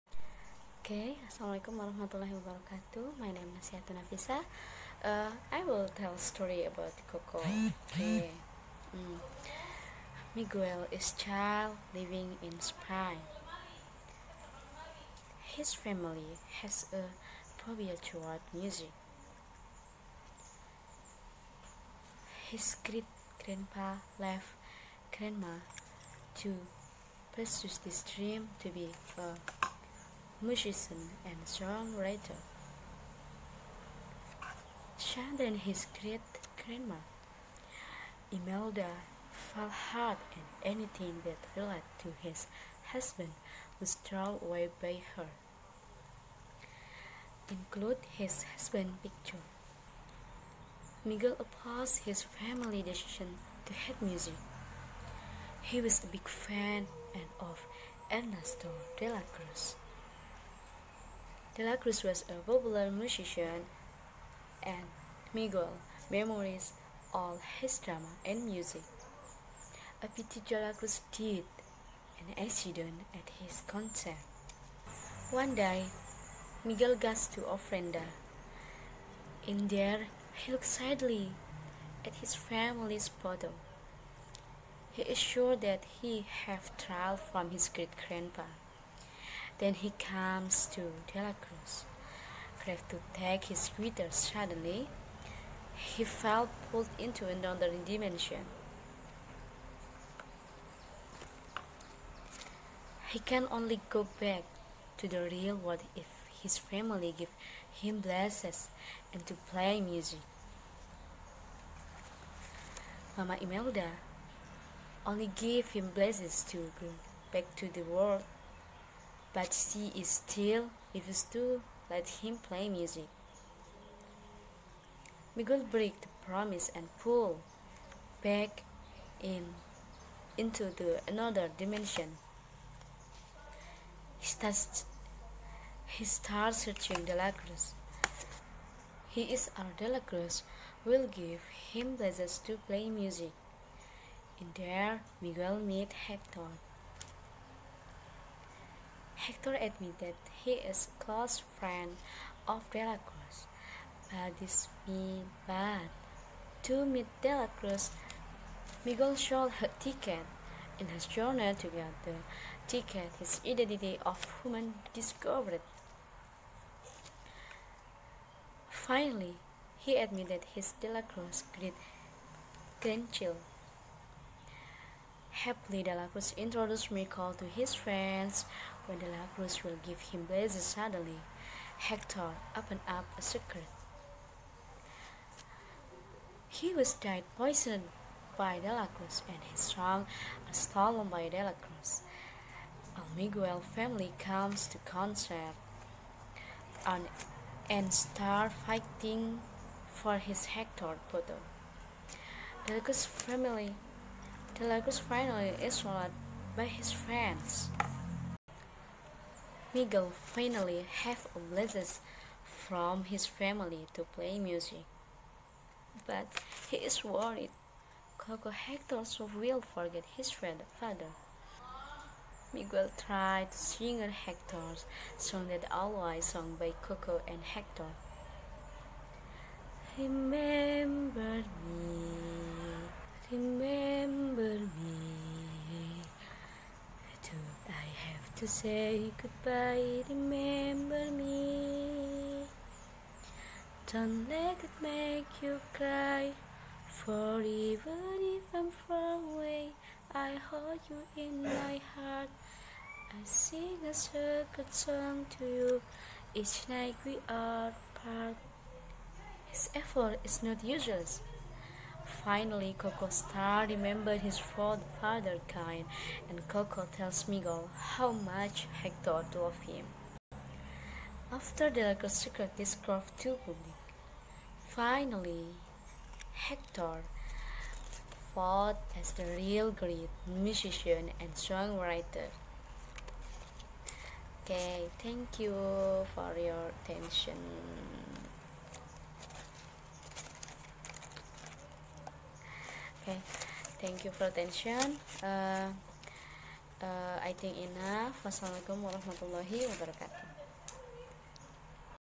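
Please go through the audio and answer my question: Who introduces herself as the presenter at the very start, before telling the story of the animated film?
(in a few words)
Yatun Nafisah.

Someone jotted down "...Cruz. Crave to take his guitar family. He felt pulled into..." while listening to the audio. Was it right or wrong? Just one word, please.
wrong.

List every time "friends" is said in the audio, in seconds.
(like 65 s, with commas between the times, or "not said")
151 s, 177 s, 206 s.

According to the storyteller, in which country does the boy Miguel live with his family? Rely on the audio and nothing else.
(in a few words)
Spain.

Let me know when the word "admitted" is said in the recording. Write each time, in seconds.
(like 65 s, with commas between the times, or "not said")
149 s, 169 s.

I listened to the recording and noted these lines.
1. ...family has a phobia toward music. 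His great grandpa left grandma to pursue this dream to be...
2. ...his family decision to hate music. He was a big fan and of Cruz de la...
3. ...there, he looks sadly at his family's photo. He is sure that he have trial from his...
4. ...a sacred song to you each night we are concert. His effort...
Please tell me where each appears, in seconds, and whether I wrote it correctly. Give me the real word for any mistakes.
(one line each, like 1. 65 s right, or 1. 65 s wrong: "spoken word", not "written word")
1. 15 s right
2. 52 s wrong: "Ernesto", not "Cruz"
3. 79 s right
4. 253 s wrong: "apart", not "concert".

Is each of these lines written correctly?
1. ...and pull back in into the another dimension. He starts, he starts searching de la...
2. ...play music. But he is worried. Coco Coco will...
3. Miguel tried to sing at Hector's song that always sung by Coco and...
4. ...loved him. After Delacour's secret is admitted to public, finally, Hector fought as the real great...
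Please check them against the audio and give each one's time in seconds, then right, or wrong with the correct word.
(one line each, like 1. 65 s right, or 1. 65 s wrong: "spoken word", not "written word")
1. 126 s right
2. 214 s wrong: "Hector", not "Coco"
3. 222 s right
4. 269 s wrong: "carved", not "admitted".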